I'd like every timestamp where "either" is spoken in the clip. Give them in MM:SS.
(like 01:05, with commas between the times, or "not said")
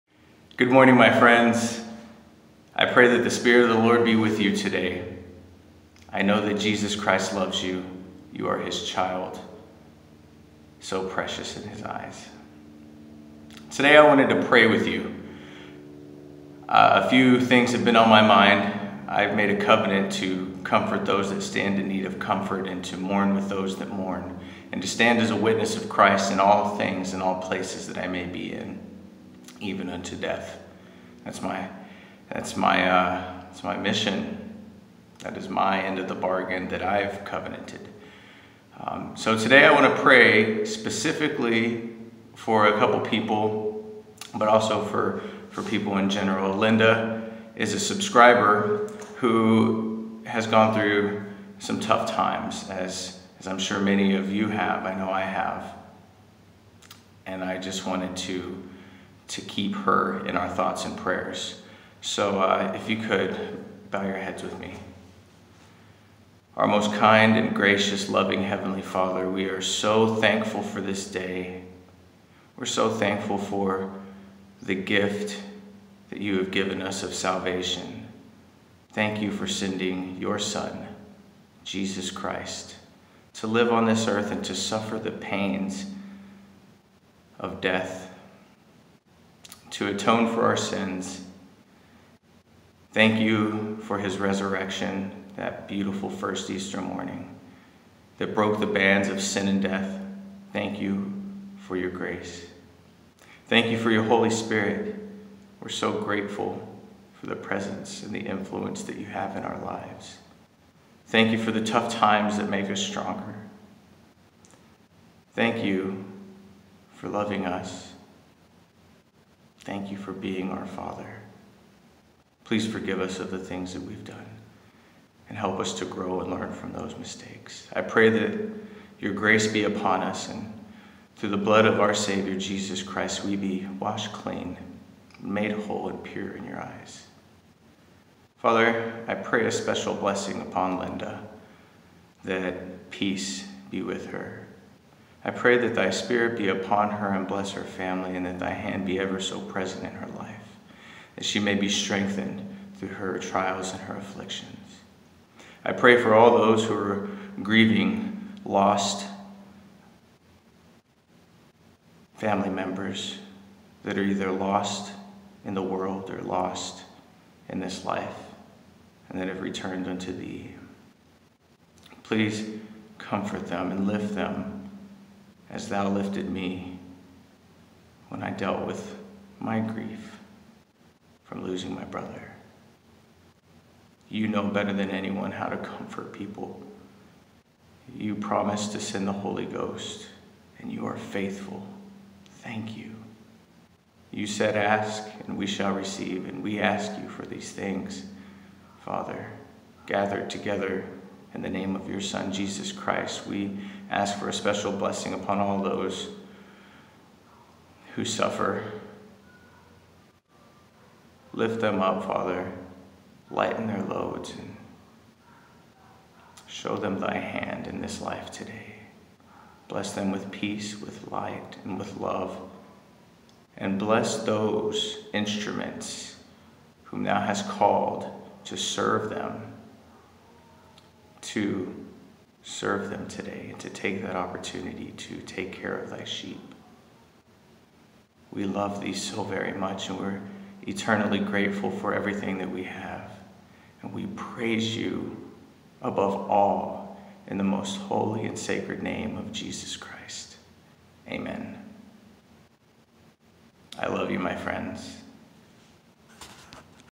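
02:44.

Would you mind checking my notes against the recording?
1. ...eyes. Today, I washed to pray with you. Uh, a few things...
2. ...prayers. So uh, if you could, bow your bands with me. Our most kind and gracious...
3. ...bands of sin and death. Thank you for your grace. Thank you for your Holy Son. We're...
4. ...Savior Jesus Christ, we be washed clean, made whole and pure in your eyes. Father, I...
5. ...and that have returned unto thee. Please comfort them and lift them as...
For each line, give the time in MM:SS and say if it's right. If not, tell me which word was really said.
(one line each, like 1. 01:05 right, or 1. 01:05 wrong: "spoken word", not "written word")
1. 00:11 wrong: "wanted", not "washed"
2. 01:00 wrong: "heads", not "bands"
3. 01:38 wrong: "Spirit", not "Son"
4. 02:11 right
5. 02:49 right.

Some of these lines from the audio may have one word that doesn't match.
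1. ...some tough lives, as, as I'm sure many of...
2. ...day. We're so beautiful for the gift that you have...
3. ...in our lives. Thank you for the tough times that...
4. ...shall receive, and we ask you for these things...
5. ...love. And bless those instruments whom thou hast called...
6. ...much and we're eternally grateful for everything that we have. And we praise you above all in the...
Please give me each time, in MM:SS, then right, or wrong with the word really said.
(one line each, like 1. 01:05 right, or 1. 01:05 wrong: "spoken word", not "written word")
1. 00:51 wrong: "times", not "lives"
2. 01:11 wrong: "thankful", not "beautiful"
3. 01:49 right
4. 03:15 right
5. 03:41 right
6. 03:59 right.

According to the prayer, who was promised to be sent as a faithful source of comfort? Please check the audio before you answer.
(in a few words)
The Holy Ghost.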